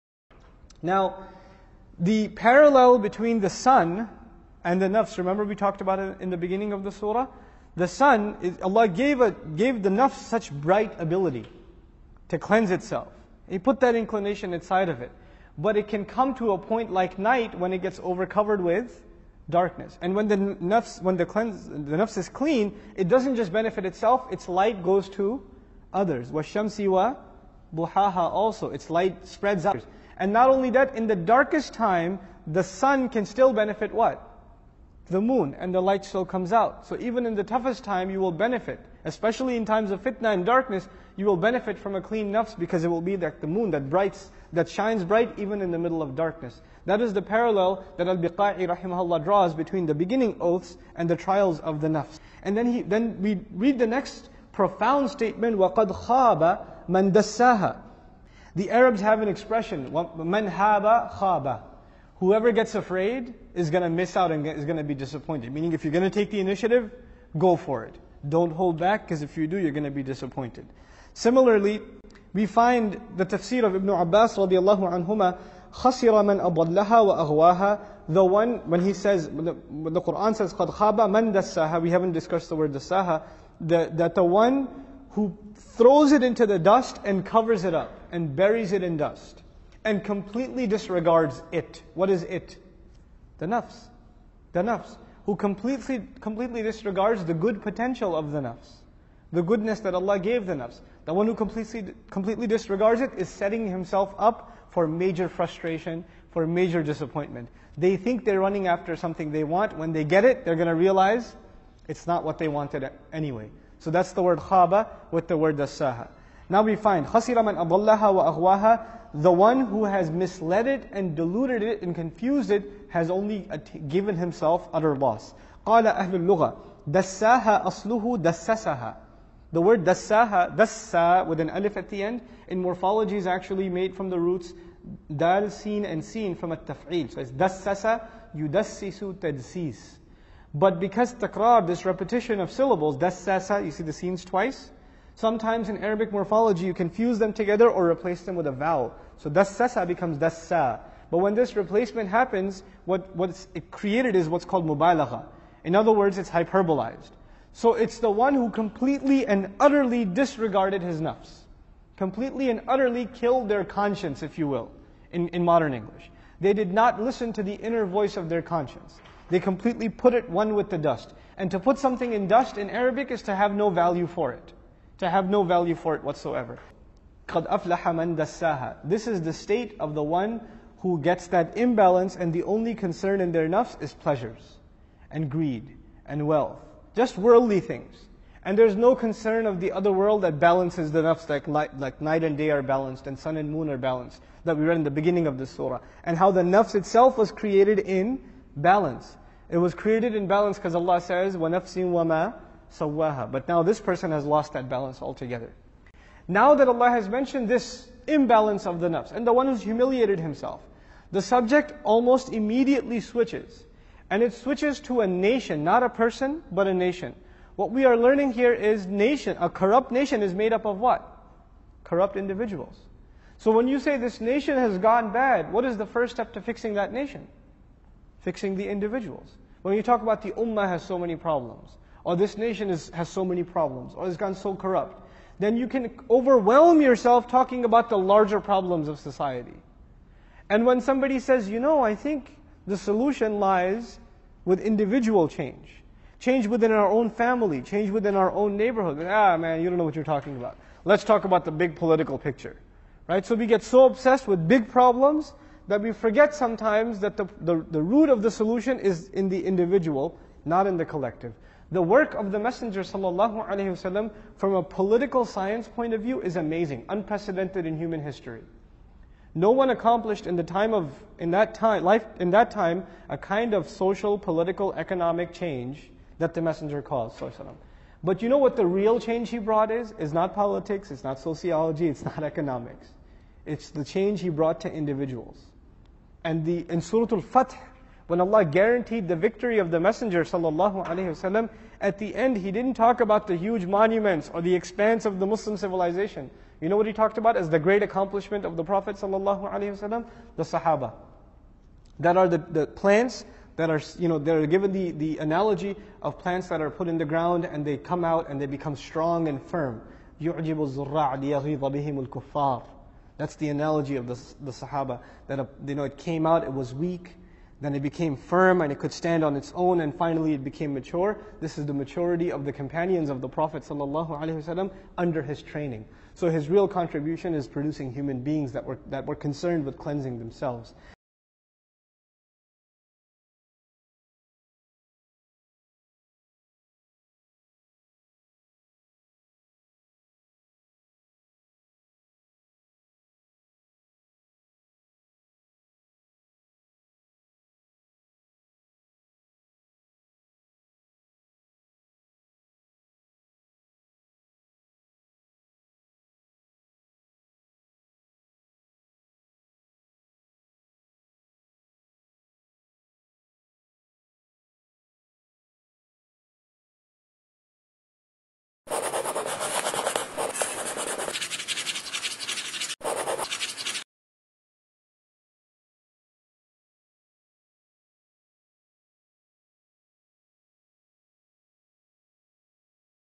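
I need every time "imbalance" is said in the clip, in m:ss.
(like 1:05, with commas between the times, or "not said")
3:01, 3:28.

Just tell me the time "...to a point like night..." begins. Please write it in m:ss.
0:16.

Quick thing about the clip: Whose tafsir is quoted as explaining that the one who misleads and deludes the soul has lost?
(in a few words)
Ibn Abbas.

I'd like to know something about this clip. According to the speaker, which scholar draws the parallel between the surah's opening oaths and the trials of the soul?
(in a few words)
Al-Biqa'i.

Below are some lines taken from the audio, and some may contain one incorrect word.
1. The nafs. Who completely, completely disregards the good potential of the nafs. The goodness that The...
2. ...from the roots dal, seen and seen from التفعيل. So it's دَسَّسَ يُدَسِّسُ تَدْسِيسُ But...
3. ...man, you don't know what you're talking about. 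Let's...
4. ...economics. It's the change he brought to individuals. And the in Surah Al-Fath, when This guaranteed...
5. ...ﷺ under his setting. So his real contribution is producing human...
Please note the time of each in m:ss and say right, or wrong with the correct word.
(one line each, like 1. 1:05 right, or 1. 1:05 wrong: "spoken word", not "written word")
1. 1:34 wrong: "Allah", not "The"
2. 2:13 right
3. 4:09 right
4. 4:42 wrong: "Allah", not "This"
5. 5:23 wrong: "training", not "setting".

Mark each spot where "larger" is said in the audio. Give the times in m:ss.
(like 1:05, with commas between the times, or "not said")
3:57.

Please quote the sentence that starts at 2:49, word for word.
They completely put it one with the dust.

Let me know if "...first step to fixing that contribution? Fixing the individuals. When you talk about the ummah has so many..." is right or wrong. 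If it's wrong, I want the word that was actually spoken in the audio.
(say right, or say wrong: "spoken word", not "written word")
wrong: "nation", not "contribution".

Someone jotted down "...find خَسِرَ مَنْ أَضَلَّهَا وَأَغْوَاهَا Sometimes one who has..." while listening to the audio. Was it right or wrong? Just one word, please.
wrong.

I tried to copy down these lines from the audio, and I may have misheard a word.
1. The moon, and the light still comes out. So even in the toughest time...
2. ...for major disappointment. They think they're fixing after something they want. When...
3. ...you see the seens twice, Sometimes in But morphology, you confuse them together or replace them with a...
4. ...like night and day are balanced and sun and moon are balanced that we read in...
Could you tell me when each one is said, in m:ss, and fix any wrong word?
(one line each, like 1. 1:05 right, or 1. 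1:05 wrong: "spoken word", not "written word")
1. 0:35 right
2. 1:46 wrong: "running", not "fixing"
3. 2:23 wrong: "Arabic", not "But"
4. 3:11 right.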